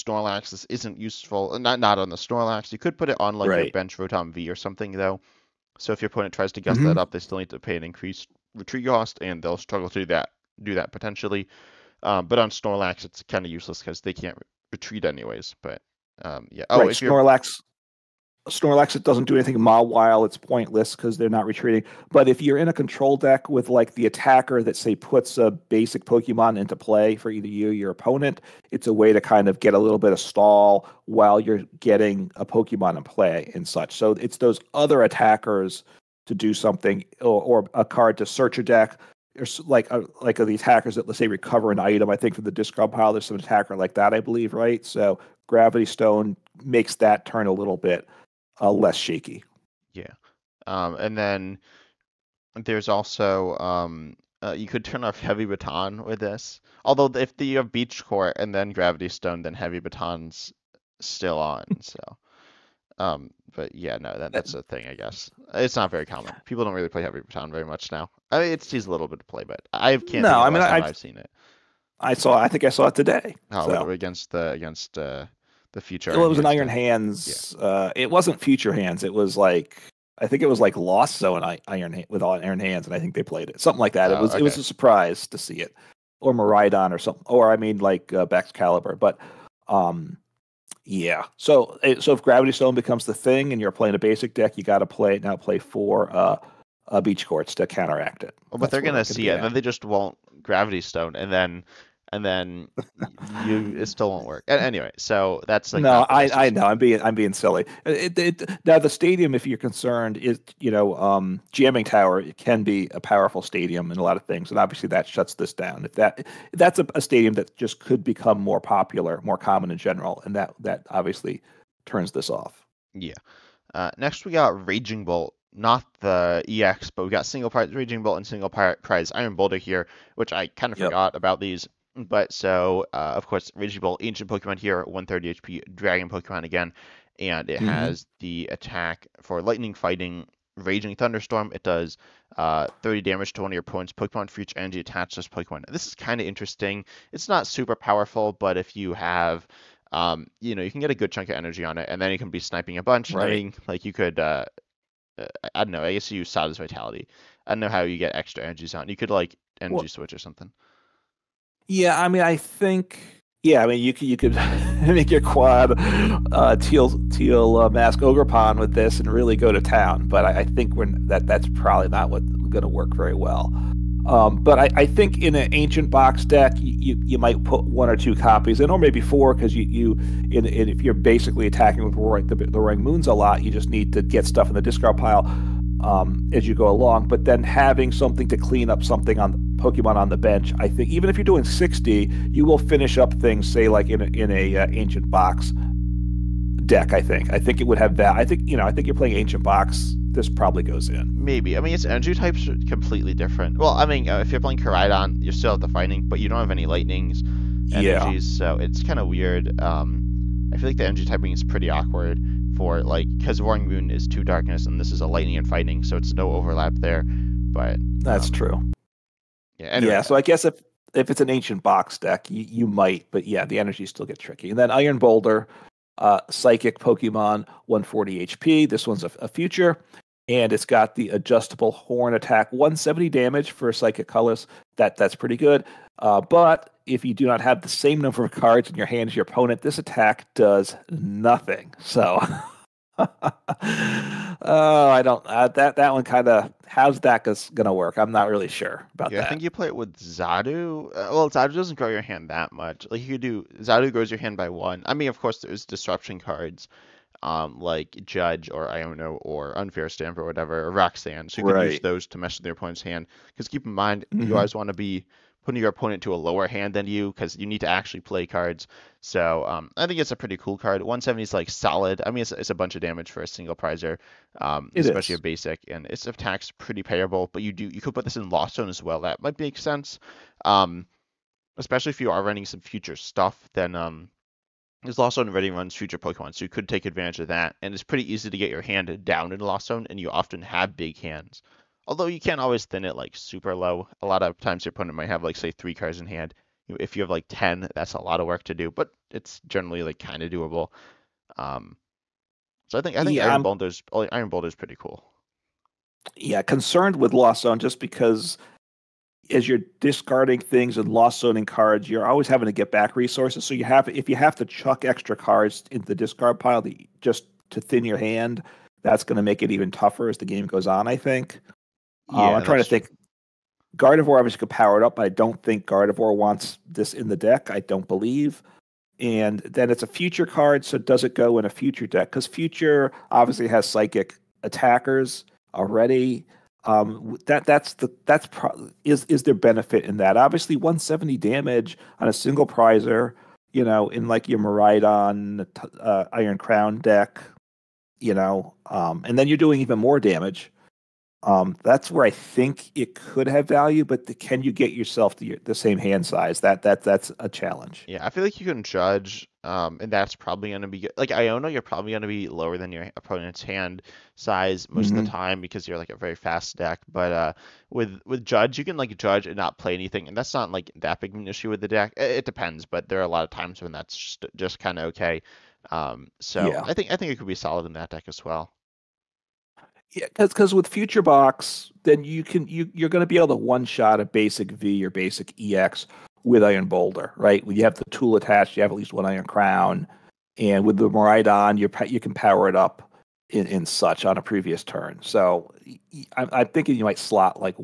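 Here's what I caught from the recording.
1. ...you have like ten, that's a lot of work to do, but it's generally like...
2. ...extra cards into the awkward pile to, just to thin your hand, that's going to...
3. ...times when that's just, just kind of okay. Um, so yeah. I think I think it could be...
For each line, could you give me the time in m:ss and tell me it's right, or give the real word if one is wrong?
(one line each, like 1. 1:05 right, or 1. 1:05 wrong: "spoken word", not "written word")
1. 4:56 right
2. 5:14 wrong: "discard", not "awkward"
3. 6:13 right.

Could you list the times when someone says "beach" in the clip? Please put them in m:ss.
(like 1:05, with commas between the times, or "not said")
0:57, 1:37.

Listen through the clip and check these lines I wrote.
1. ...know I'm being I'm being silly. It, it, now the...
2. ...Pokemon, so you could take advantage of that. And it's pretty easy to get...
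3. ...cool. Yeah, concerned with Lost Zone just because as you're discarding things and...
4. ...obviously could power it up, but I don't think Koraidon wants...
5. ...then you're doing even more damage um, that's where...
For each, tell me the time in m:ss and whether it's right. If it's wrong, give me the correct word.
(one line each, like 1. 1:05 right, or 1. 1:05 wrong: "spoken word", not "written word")
1. 1:46 right
2. 4:45 right
3. 5:04 right
4. 5:24 wrong: "Gardevoir", not "Koraidon"
5. 5:49 right.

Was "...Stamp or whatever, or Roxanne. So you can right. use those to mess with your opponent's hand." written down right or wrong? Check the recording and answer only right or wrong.
right.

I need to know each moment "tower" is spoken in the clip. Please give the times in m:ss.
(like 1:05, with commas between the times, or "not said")
1:51.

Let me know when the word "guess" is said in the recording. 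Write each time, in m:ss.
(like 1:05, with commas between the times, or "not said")
0:06, 1:04, 2:35, 3:40.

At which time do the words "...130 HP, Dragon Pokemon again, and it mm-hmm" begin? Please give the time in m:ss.
2:14.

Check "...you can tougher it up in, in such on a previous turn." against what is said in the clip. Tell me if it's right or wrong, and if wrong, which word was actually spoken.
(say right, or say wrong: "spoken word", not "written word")
wrong: "power", not "tougher".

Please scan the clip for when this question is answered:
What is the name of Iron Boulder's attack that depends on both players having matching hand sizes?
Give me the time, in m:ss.
3:51.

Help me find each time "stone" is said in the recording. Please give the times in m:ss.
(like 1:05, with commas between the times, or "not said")
0:45, 0:59, 1:32, 1:40.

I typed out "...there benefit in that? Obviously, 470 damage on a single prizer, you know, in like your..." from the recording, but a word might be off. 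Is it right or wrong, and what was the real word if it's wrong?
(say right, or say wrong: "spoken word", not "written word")
wrong: "170", not "470".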